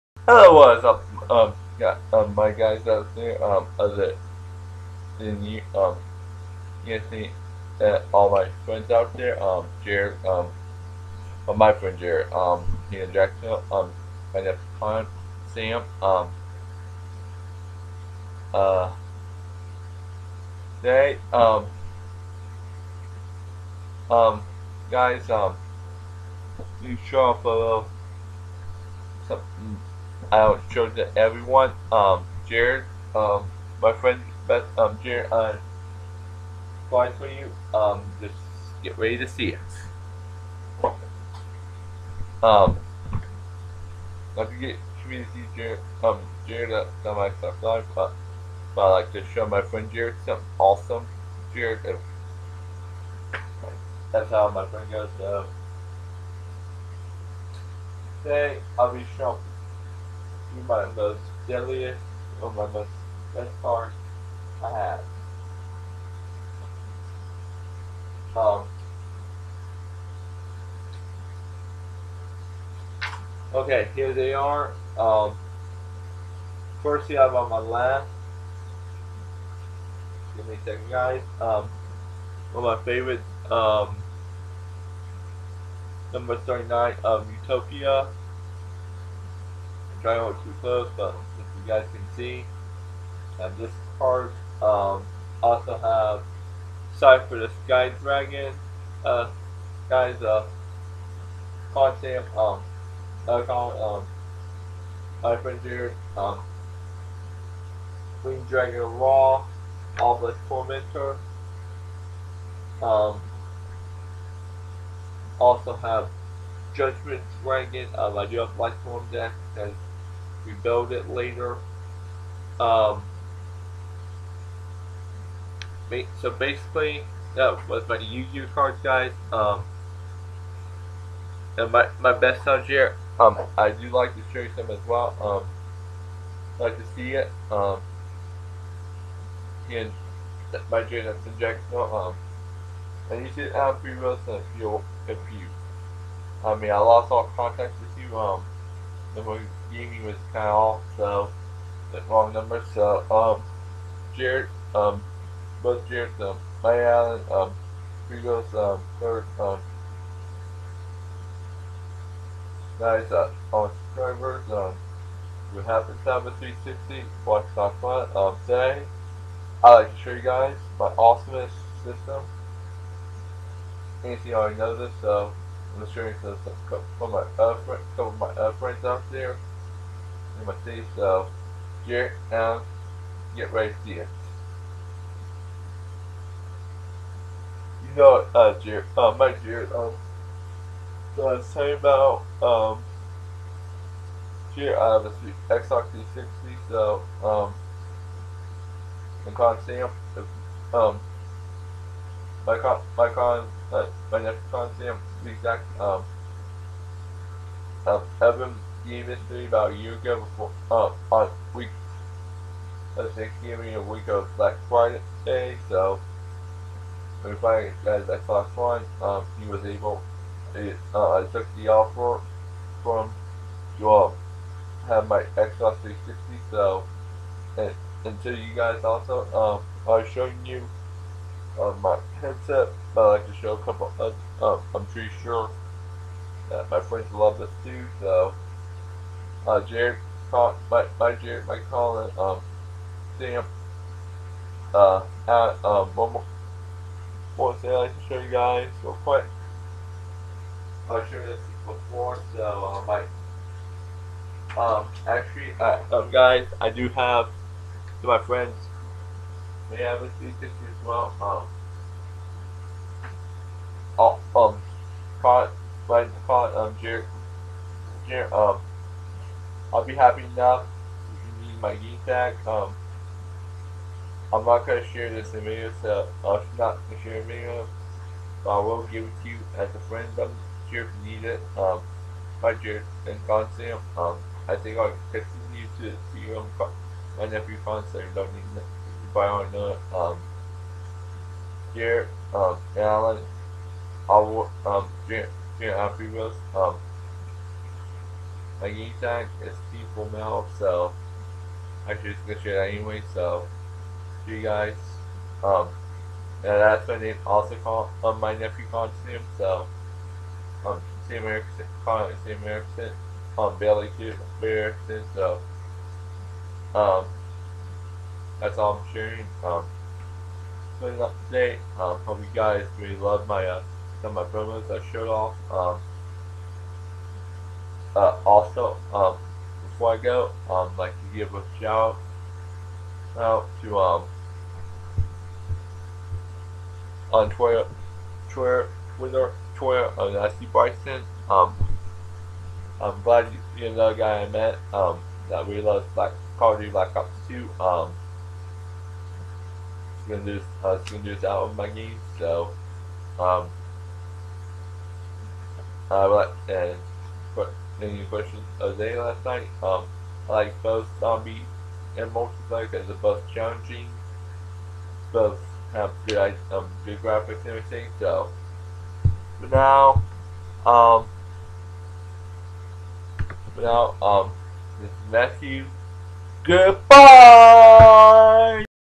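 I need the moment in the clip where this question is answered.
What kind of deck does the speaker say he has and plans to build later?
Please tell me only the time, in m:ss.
1:58.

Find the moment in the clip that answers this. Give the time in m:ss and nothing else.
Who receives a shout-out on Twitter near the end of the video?
5:40.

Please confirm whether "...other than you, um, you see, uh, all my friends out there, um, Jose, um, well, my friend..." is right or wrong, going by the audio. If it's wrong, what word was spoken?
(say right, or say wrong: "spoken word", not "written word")
wrong: "Jared", not "Jose".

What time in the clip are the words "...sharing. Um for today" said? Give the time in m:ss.
5:18.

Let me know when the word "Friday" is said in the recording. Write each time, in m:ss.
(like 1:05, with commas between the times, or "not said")
3:34.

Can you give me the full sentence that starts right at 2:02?
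Um, so basically, that was my Yu-Gi-Oh cards, guys.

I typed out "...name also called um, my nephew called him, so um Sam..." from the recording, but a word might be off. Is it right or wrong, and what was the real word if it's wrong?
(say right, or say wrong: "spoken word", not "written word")
right.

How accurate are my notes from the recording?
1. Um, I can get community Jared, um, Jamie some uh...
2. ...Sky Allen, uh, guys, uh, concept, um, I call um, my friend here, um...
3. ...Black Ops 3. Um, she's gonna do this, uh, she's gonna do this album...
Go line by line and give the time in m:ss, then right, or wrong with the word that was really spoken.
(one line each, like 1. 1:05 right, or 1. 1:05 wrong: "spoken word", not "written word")
1. 0:42 wrong: "Jared", not "Jamie"
2. 1:37 wrong: "Dragon", not "Allen"
3. 5:46 wrong: "2", not "3".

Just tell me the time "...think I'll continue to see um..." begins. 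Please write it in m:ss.
4:44.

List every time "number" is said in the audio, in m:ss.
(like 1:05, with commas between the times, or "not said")
1:26, 2:32.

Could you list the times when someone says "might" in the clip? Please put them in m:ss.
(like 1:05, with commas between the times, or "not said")
4:14.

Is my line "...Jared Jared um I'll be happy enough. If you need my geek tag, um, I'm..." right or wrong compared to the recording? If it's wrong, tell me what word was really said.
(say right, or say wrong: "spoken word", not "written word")
right.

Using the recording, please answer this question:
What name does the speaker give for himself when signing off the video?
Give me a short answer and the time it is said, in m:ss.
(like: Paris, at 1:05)
Matthew, at 6:15.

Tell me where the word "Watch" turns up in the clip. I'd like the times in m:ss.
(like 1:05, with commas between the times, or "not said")
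2:47.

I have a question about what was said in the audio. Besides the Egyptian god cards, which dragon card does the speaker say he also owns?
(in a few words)
Judgment Dragon.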